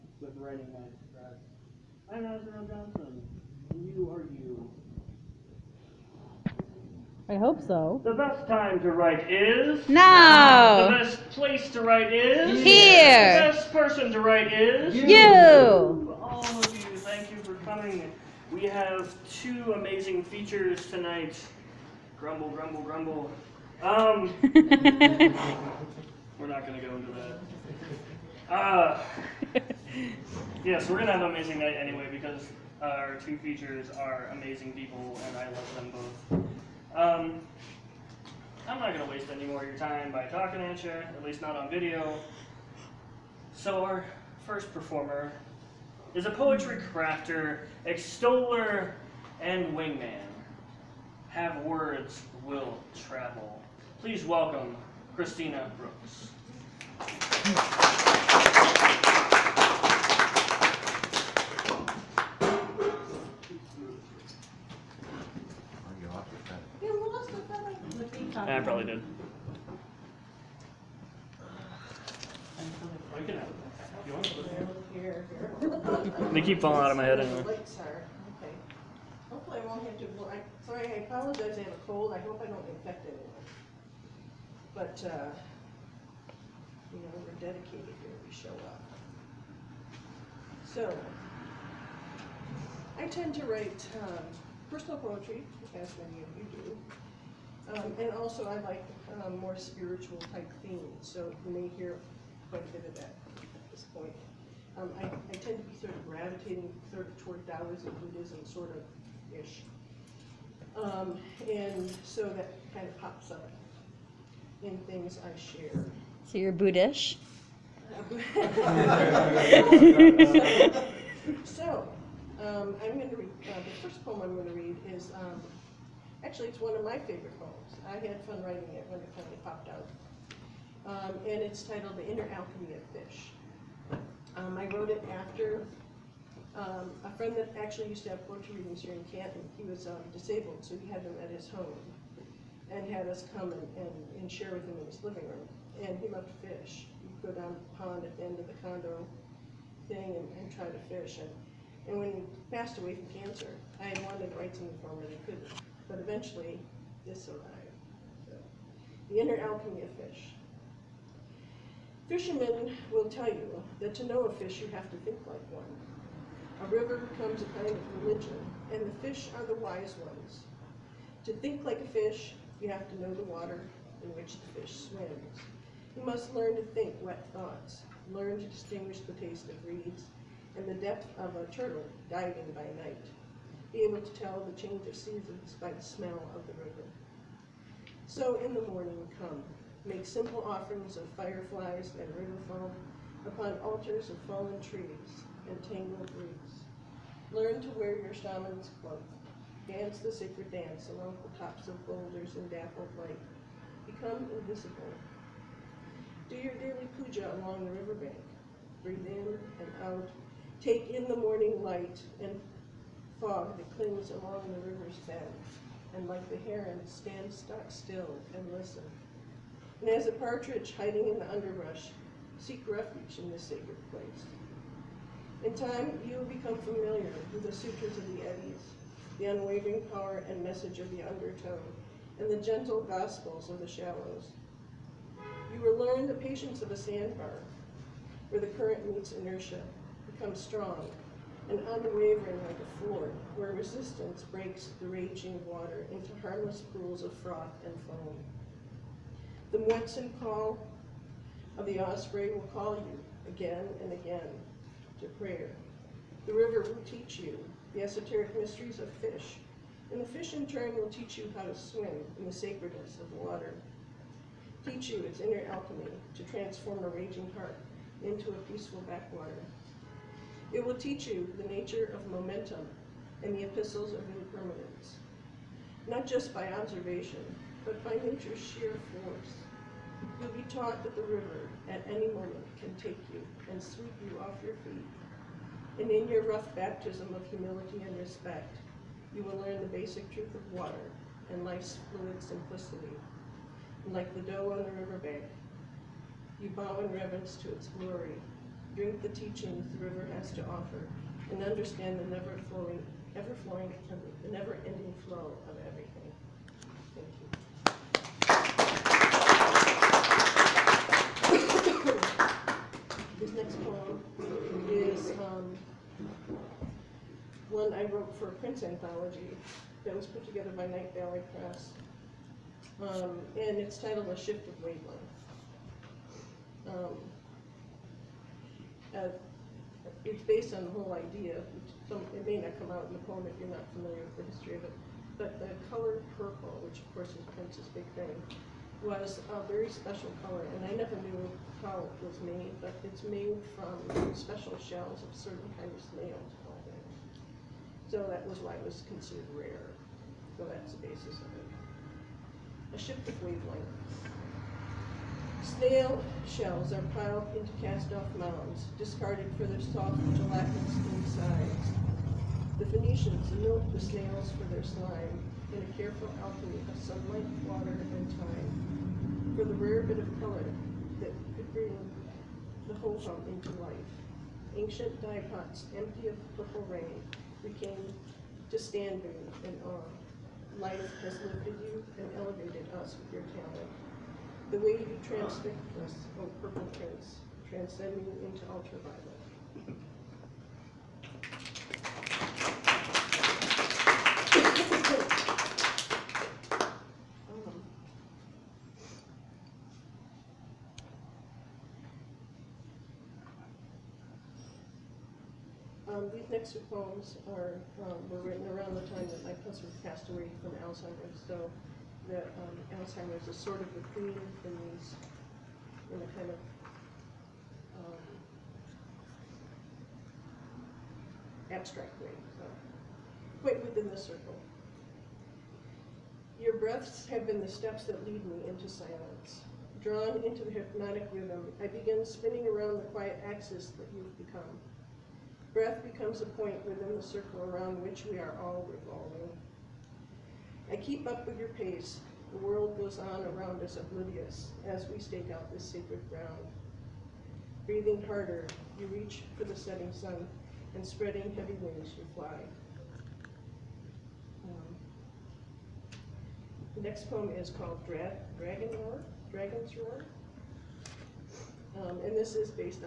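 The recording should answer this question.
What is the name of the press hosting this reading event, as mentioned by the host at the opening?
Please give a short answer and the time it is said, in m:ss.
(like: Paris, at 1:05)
Writing Knights Press, at 0:00.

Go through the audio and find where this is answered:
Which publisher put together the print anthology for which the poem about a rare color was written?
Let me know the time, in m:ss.
5:20.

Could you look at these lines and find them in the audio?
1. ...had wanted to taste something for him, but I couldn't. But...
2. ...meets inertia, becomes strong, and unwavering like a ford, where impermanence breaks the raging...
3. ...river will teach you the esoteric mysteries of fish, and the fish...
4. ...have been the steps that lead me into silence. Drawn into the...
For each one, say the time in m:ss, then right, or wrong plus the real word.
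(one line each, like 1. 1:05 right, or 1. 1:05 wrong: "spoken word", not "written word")
1. 2:33 wrong: "write", not "taste"
2. 3:58 wrong: "resistance", not "impermanence"
3. 4:16 right
4. 7:07 right.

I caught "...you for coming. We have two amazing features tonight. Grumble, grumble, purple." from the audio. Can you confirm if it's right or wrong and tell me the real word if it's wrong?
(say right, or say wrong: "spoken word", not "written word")
wrong: "grumble", not "purple".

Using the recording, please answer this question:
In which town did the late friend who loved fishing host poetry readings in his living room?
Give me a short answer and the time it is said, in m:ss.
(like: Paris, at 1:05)
Canton, at 2:19.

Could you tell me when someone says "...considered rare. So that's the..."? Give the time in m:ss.
5:48.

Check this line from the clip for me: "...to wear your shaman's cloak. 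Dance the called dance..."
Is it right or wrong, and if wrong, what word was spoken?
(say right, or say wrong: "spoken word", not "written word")
wrong: "sacred", not "called".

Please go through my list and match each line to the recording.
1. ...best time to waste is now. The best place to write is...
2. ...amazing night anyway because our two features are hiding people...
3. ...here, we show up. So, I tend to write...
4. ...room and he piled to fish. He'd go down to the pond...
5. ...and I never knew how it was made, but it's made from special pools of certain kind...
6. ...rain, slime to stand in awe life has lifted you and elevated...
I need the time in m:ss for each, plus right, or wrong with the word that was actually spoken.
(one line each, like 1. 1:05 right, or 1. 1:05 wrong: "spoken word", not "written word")
1. 0:08 wrong: "write", not "waste"
2. 0:31 wrong: "amazing", not "hiding"
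3. 1:28 right
4. 2:25 wrong: "loved", not "piled"
5. 5:40 wrong: "shells", not "pools"
6. 6:16 wrong: "became", not "slime".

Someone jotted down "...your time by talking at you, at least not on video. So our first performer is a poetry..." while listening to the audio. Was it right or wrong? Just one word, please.
right.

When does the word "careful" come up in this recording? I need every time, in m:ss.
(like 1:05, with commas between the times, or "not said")
6:05.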